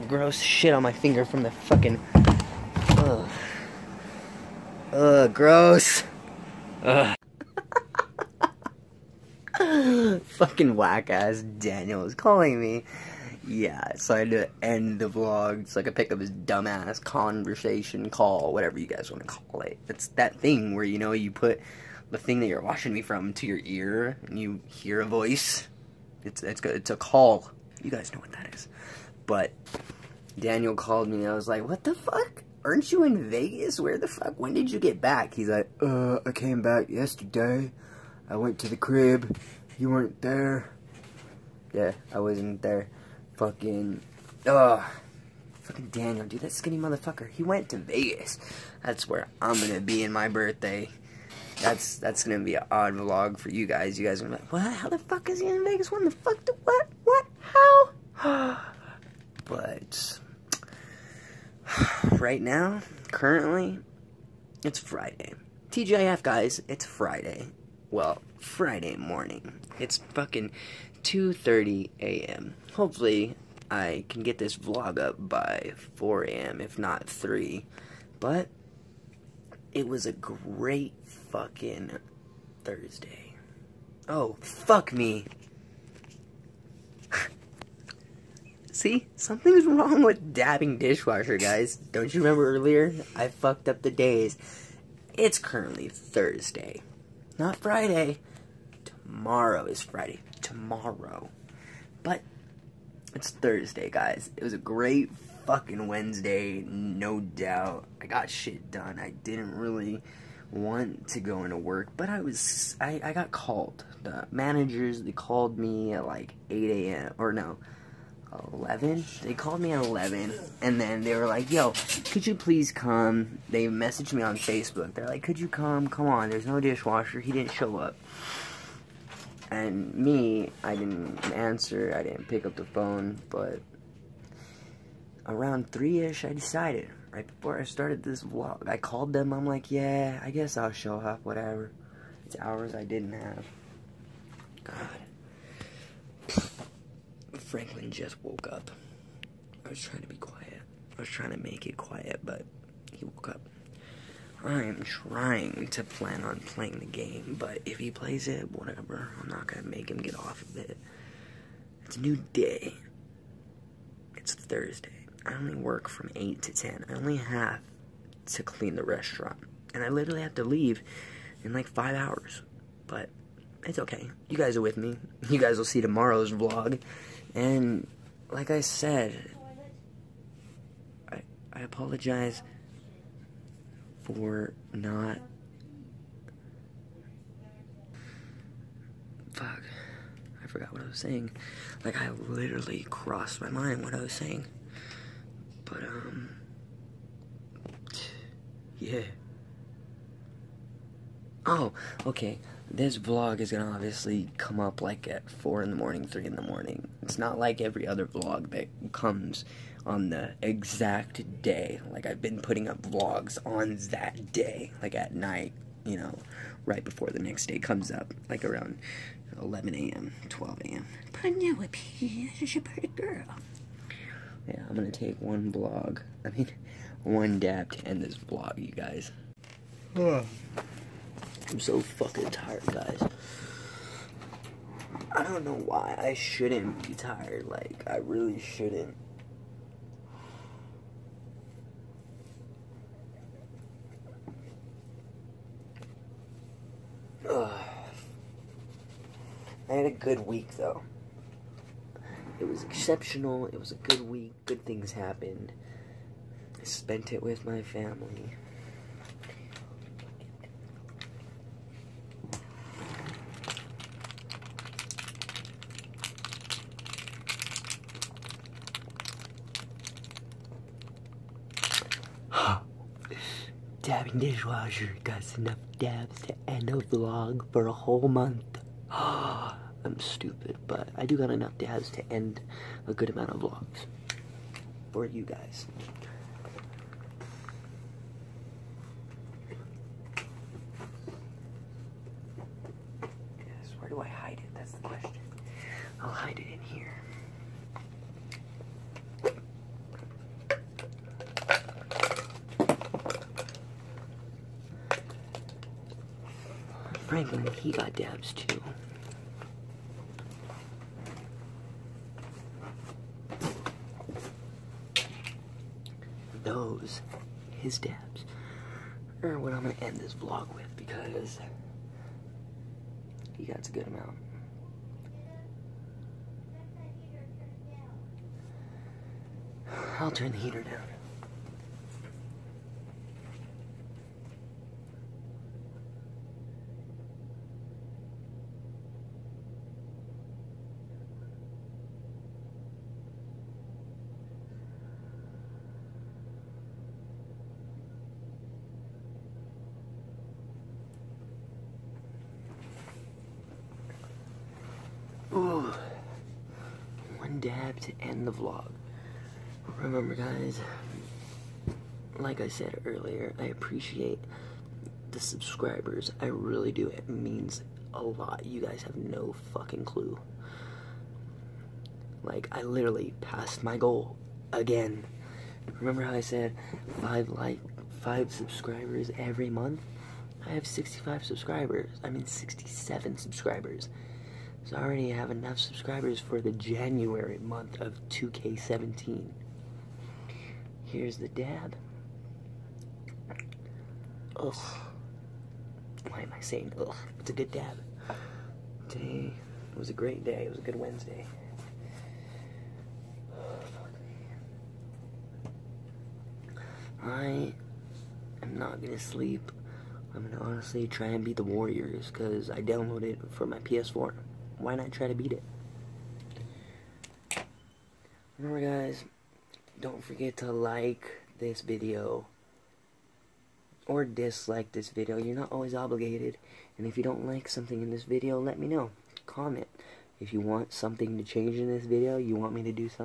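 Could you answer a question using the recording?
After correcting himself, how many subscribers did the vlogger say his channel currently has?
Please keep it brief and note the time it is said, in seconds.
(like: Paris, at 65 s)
67, at 382 s.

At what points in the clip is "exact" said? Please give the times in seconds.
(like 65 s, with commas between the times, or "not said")
210 s.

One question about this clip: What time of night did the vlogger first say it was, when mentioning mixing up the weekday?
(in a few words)
2:30 a.m.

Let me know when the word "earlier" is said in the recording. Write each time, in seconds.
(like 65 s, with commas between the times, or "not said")
92 s, 362 s.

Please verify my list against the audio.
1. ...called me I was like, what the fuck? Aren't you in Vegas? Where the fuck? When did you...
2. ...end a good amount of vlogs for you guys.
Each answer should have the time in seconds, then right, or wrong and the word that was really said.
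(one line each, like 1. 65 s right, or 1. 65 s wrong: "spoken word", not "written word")
1. 30 s right
2. 282 s right.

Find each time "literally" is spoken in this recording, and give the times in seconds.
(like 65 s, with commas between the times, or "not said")
169 s, 192 s, 372 s.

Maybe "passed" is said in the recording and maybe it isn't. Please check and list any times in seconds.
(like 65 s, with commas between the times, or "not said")
373 s.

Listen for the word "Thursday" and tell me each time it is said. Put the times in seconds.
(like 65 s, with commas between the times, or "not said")
82 s, 95 s, 103 s, 164 s.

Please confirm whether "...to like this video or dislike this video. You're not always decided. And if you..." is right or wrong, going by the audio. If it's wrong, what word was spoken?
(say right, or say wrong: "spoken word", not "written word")
wrong: "obligated", not "decided".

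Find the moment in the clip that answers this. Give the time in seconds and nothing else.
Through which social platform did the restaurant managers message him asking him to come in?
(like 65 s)
124 s.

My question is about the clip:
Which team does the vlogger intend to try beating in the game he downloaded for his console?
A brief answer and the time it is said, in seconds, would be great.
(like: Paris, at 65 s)
Warriors, at 411 s.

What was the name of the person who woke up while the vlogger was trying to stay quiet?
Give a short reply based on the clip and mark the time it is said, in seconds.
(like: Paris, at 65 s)
Franklin, at 147 s.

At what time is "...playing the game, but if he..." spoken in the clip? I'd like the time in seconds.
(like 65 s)
156 s.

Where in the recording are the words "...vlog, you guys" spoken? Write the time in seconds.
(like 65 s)
228 s.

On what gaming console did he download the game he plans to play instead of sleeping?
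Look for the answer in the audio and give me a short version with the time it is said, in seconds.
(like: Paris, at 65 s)
PS4, at 413 s.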